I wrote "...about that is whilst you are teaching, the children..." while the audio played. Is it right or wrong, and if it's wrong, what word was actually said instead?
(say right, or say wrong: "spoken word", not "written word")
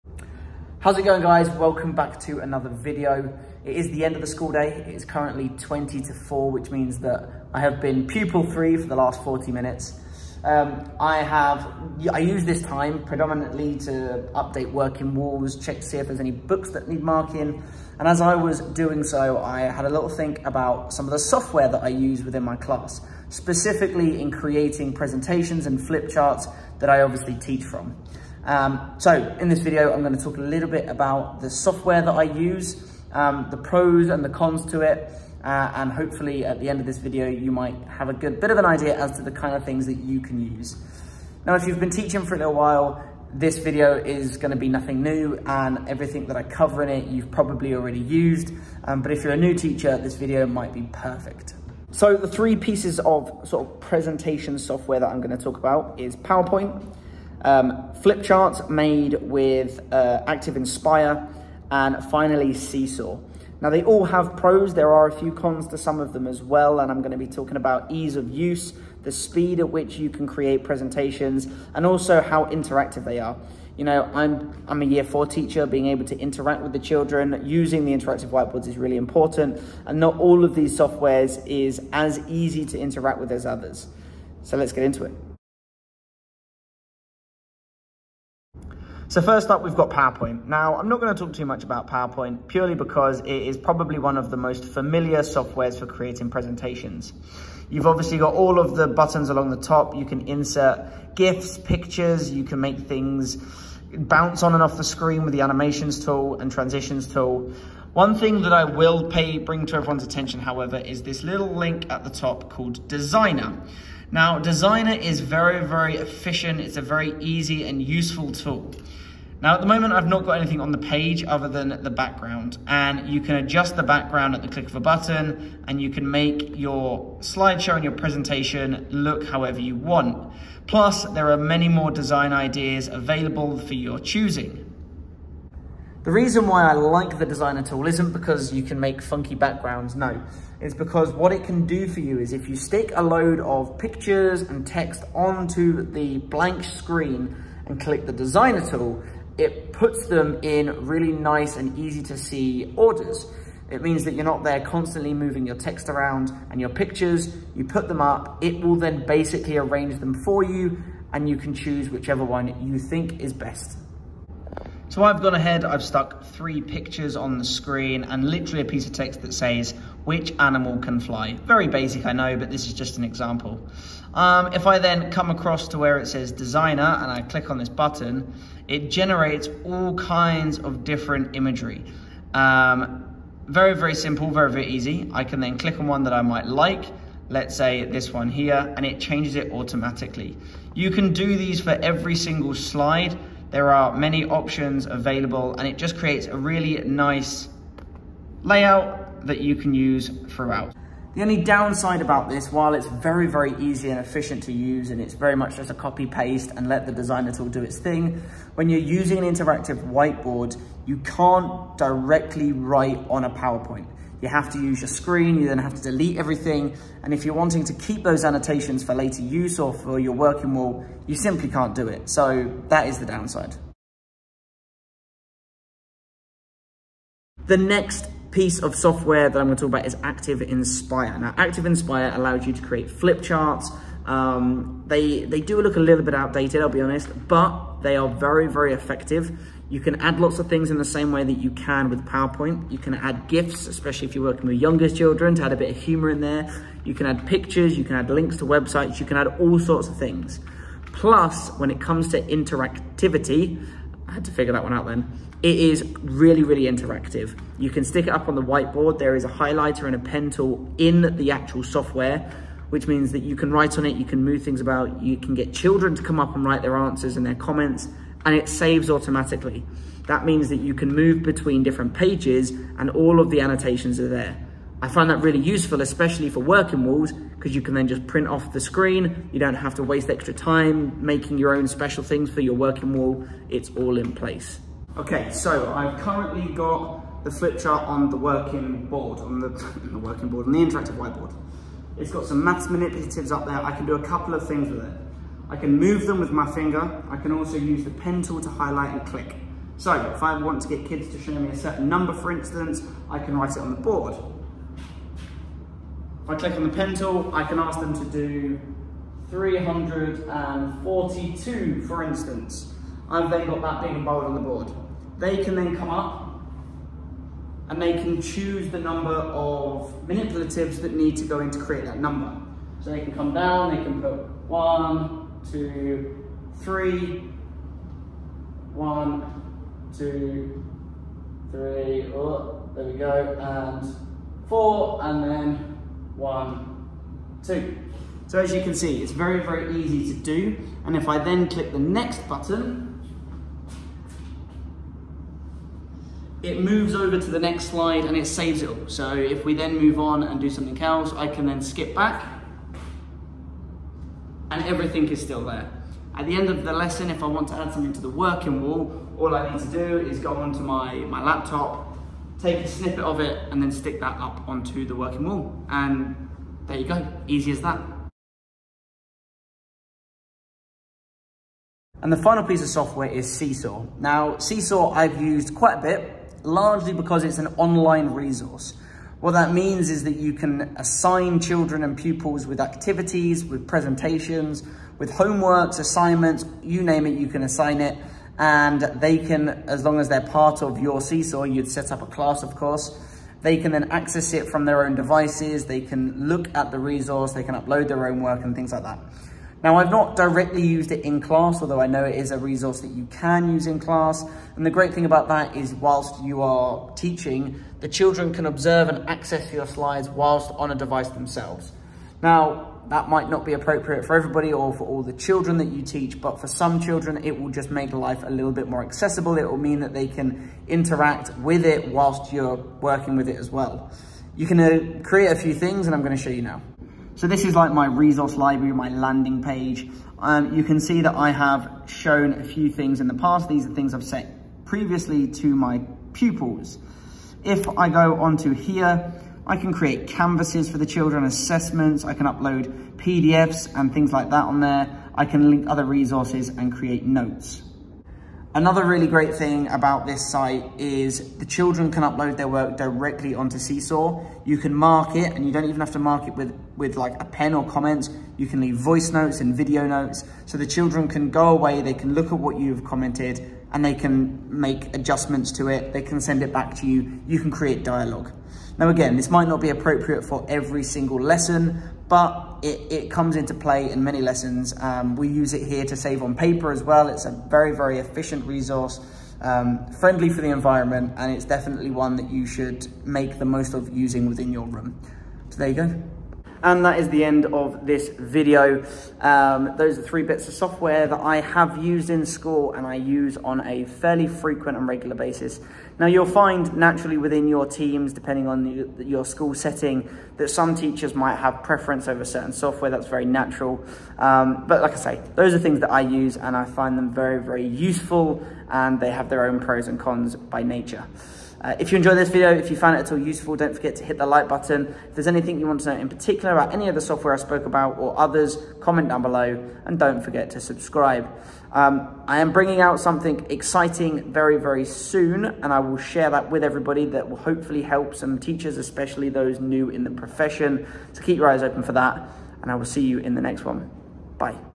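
right.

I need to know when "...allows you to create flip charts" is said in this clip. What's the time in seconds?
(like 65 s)
232 s.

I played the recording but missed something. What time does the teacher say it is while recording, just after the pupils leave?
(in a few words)
20 to four.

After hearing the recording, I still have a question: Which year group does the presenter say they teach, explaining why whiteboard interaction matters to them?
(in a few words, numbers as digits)
Year four.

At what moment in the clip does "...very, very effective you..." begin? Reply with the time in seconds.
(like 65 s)
238 s.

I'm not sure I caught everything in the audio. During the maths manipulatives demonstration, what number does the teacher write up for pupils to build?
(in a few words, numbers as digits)
342.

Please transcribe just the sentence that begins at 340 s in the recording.
And if I then click the next button, it moves over to the next slide and it saves it all.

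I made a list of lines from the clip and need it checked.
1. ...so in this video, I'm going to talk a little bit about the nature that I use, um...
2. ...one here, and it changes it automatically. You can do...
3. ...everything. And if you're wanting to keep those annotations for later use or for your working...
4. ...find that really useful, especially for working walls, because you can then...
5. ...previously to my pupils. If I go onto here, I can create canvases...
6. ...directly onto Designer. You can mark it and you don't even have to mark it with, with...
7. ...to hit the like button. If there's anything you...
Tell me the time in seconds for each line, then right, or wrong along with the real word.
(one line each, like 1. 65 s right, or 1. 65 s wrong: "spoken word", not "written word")
1. 28 s wrong: "software", not "nature"
2. 188 s right
3. 216 s right
4. 274 s right
5. 434 s right
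6. 452 s wrong: "Seesaw", not "Designer"
7. 513 s right.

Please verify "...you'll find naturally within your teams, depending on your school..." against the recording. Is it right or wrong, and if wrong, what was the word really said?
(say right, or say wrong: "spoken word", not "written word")
right.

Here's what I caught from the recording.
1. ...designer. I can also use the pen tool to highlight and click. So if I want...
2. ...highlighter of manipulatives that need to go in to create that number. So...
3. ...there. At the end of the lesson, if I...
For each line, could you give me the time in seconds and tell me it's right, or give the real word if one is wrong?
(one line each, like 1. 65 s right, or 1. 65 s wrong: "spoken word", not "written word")
1. 296 s wrong: "finger", not "designer"
2. 318 s wrong: "number", not "highlighter"
3. 355 s right.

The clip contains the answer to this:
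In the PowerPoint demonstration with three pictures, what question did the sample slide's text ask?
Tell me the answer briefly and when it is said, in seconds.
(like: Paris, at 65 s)
Which animal can fly, at 170 s.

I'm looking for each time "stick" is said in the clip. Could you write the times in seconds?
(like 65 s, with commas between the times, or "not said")
142 s, 257 s, 363 s.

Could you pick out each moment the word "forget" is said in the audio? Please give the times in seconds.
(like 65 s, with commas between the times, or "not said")
513 s, 520 s.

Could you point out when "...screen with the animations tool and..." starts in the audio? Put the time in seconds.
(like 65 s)
104 s.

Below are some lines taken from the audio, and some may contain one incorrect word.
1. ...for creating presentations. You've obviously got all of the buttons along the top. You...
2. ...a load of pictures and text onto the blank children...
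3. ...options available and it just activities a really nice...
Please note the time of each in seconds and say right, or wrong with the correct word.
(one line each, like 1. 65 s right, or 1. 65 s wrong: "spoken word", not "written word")
1. 95 s right
2. 142 s wrong: "screen", not "children"
3. 194 s wrong: "creates", not "activities".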